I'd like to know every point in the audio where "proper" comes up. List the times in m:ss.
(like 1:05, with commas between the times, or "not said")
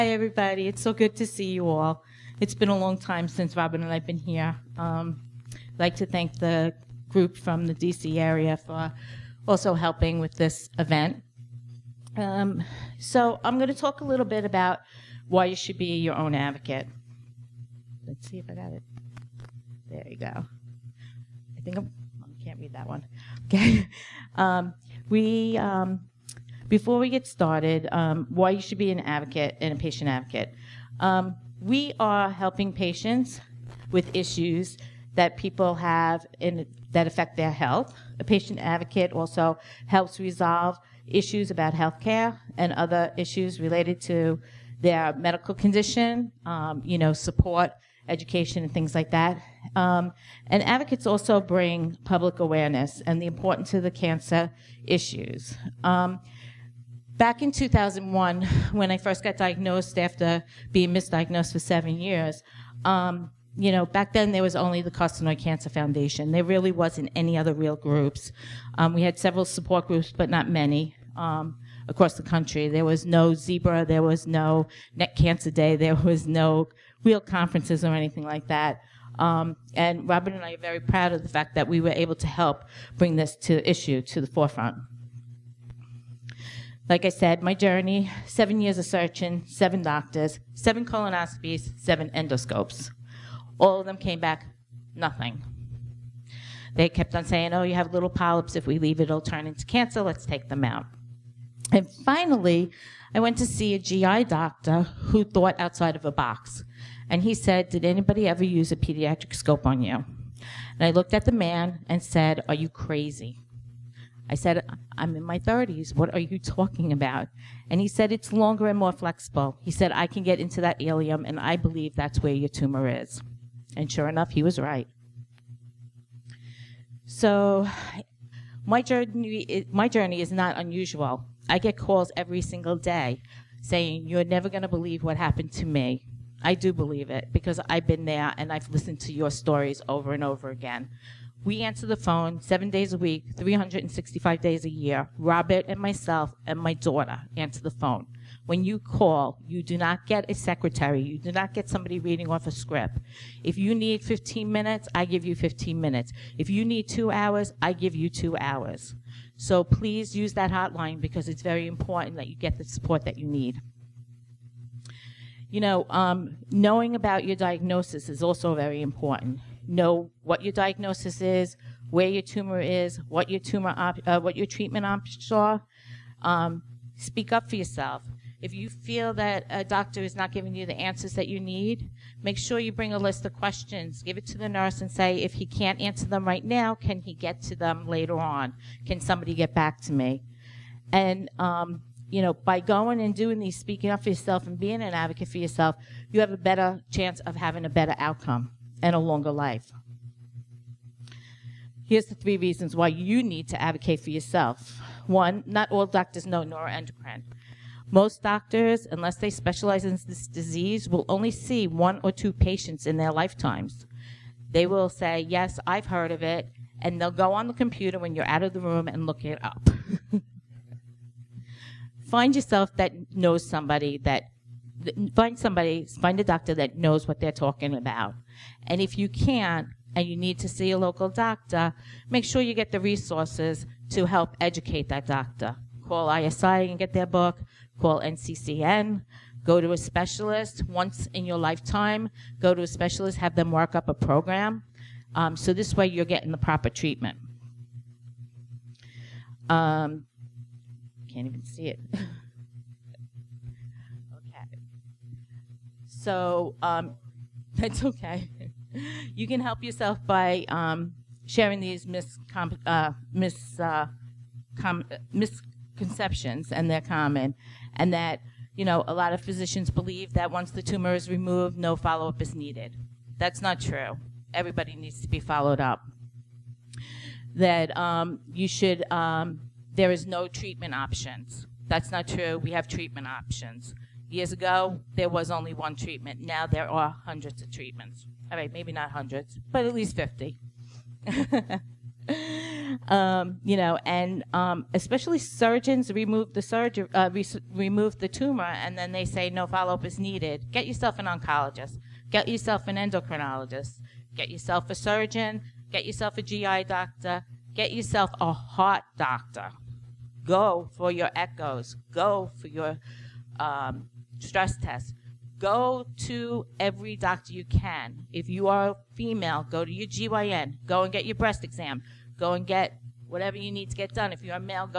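4:06.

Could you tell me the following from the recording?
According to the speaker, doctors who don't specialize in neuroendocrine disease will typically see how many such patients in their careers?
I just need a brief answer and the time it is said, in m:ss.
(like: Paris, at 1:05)
1 or 2, at 3:31.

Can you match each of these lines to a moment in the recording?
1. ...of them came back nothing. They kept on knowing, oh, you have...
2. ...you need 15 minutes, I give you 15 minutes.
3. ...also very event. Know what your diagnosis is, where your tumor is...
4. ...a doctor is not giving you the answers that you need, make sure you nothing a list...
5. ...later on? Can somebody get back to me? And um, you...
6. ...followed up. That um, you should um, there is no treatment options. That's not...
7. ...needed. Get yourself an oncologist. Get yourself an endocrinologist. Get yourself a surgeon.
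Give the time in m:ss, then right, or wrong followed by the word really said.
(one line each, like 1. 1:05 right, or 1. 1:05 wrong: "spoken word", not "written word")
1. 1:33 wrong: "saying", not "knowing"
2. 2:33 right
3. 2:48 wrong: "important", not "event"
4. 2:59 wrong: "bring", not "nothing"
5. 3:07 right
6. 4:35 right
7. 4:59 right.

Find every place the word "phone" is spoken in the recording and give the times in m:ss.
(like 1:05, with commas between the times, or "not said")
2:21, 2:27.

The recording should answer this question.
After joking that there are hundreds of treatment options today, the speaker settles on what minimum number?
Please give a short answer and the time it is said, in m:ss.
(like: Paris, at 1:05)
at least 50, at 4:49.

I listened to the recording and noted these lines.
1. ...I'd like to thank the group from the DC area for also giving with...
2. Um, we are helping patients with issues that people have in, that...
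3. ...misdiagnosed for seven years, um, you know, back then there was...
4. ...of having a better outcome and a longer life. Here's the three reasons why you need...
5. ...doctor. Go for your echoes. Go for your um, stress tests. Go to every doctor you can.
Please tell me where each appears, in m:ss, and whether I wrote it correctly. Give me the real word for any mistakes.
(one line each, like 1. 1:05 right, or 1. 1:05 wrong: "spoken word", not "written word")
1. 0:05 wrong: "helping", not "giving"
2. 0:31 right
3. 1:00 right
4. 3:17 right
5. 5:08 right.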